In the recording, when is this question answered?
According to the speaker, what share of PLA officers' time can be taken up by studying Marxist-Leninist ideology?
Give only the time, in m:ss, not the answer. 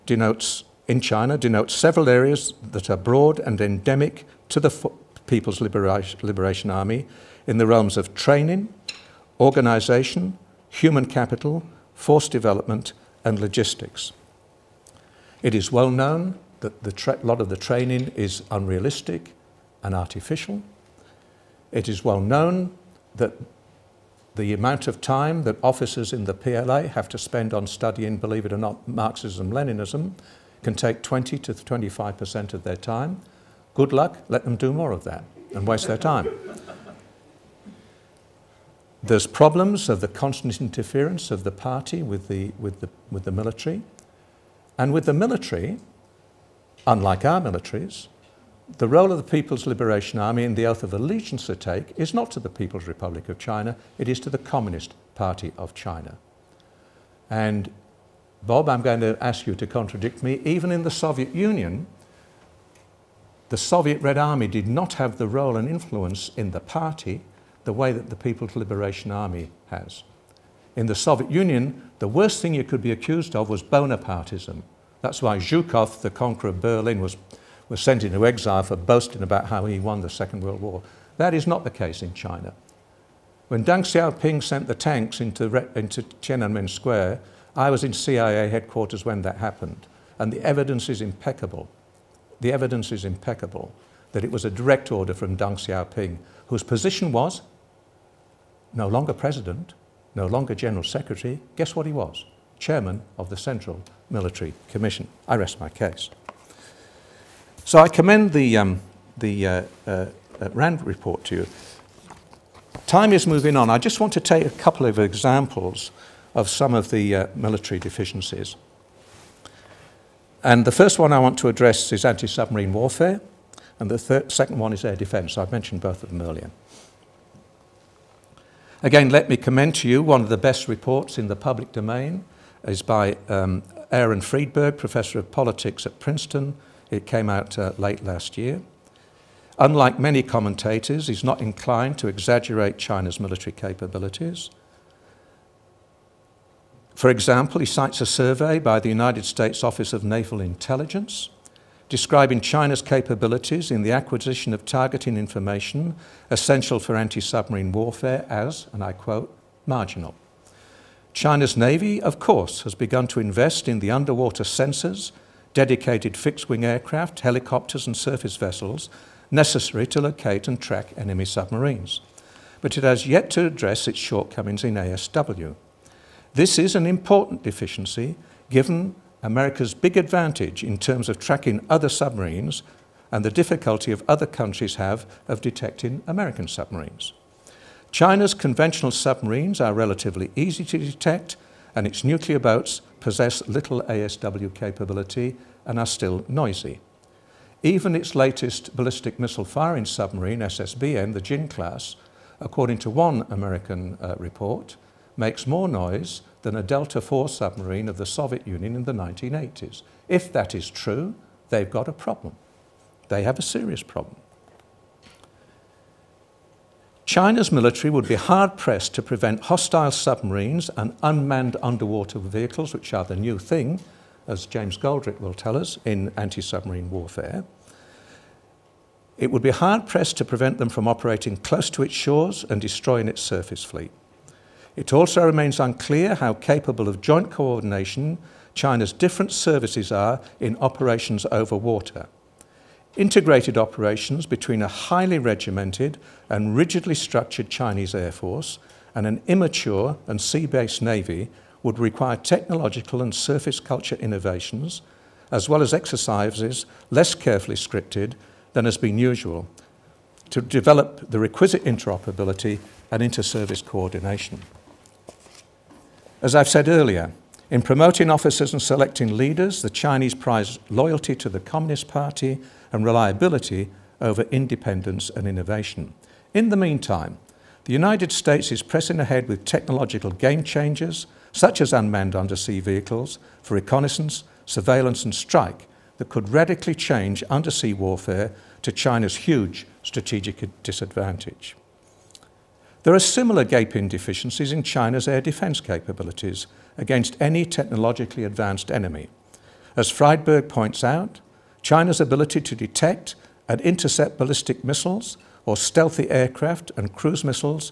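0:31.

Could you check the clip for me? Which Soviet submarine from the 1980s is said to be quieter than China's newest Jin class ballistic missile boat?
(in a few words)
Delta IV.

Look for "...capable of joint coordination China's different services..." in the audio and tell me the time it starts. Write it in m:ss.
3:56.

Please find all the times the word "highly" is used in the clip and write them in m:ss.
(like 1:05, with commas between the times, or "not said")
4:04.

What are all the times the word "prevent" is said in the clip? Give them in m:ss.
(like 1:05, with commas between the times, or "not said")
3:39, 3:50.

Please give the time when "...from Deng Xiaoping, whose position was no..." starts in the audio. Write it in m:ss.
1:35.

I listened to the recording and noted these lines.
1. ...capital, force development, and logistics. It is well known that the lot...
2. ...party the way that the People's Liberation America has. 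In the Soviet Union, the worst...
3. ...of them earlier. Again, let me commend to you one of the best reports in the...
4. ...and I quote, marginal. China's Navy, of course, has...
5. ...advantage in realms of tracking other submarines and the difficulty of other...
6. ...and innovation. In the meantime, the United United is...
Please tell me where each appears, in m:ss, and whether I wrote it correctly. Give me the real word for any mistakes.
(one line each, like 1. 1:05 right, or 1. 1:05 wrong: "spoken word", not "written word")
1. 0:11 right
2. 1:06 wrong: "Army", not "America"
3. 2:06 right
4. 2:38 right
5. 2:59 wrong: "terms", not "realms"
6. 4:35 wrong: "States", not "United".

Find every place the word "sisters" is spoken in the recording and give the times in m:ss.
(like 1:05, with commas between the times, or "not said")
not said.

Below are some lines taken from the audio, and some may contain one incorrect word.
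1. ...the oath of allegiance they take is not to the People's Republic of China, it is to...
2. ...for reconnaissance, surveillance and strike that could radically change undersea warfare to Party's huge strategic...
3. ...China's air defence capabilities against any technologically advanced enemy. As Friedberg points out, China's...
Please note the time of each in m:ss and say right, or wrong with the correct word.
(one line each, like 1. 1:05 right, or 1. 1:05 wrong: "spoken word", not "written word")
1. 0:50 right
2. 4:43 wrong: "China", not "Party"
3. 4:54 right.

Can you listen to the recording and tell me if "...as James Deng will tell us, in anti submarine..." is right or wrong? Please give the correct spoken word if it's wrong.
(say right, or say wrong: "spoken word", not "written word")
wrong: "Goldrick", not "Deng".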